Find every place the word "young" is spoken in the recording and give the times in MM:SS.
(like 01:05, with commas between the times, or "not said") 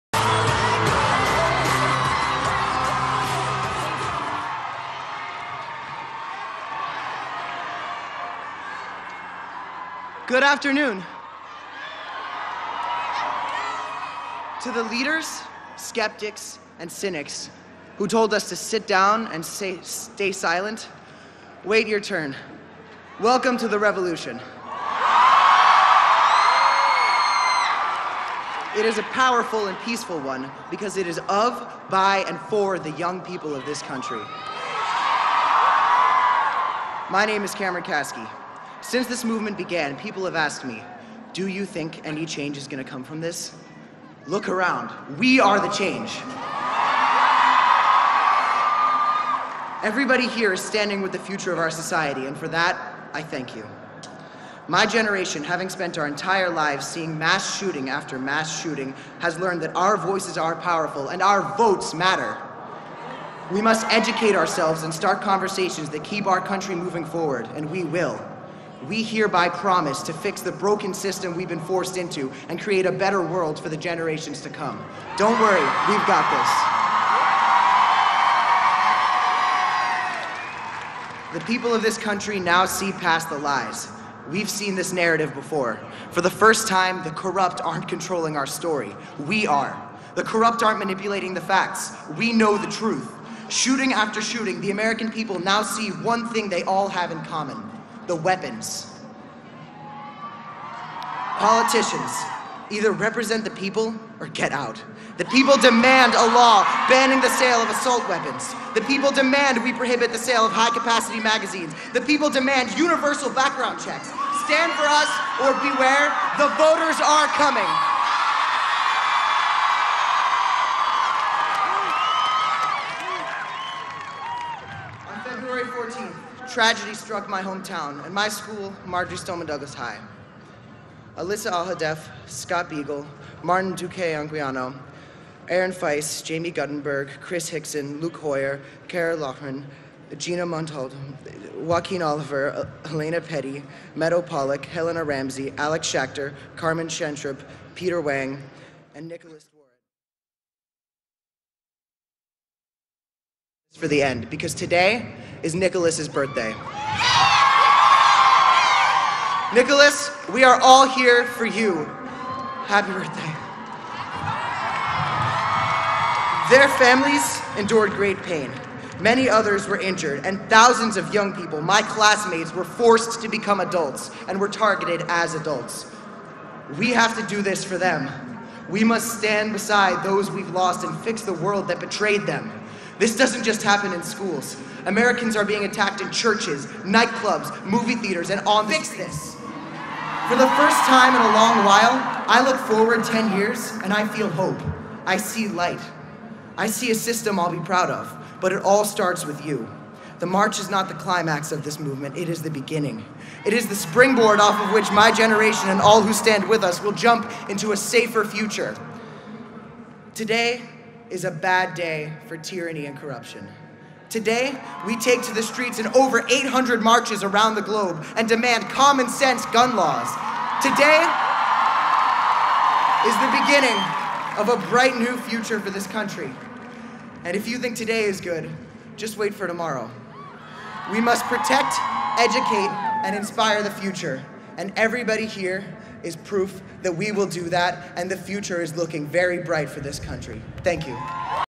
00:32, 02:51.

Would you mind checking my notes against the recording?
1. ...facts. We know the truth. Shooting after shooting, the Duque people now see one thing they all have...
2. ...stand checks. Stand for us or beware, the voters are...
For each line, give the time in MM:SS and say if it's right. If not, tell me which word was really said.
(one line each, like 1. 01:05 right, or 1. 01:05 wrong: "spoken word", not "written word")
1. 01:31 wrong: "American", not "Duque"
2. 01:53 wrong: "background", not "stand".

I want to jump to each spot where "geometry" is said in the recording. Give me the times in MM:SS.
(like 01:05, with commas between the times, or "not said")
not said.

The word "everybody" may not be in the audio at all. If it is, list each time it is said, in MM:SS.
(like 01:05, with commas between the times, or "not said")
00:49, 03:54.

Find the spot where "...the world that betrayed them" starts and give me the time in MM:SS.
03:01.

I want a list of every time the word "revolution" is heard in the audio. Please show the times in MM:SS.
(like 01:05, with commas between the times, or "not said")
00:23.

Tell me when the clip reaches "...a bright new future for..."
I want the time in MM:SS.
03:44.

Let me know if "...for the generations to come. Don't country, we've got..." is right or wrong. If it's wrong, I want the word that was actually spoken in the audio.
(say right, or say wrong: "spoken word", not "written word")
wrong: "worry", not "country".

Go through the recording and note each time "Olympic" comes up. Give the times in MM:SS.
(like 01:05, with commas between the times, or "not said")
not said.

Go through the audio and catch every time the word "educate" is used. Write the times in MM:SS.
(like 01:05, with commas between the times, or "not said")
01:03, 03:52.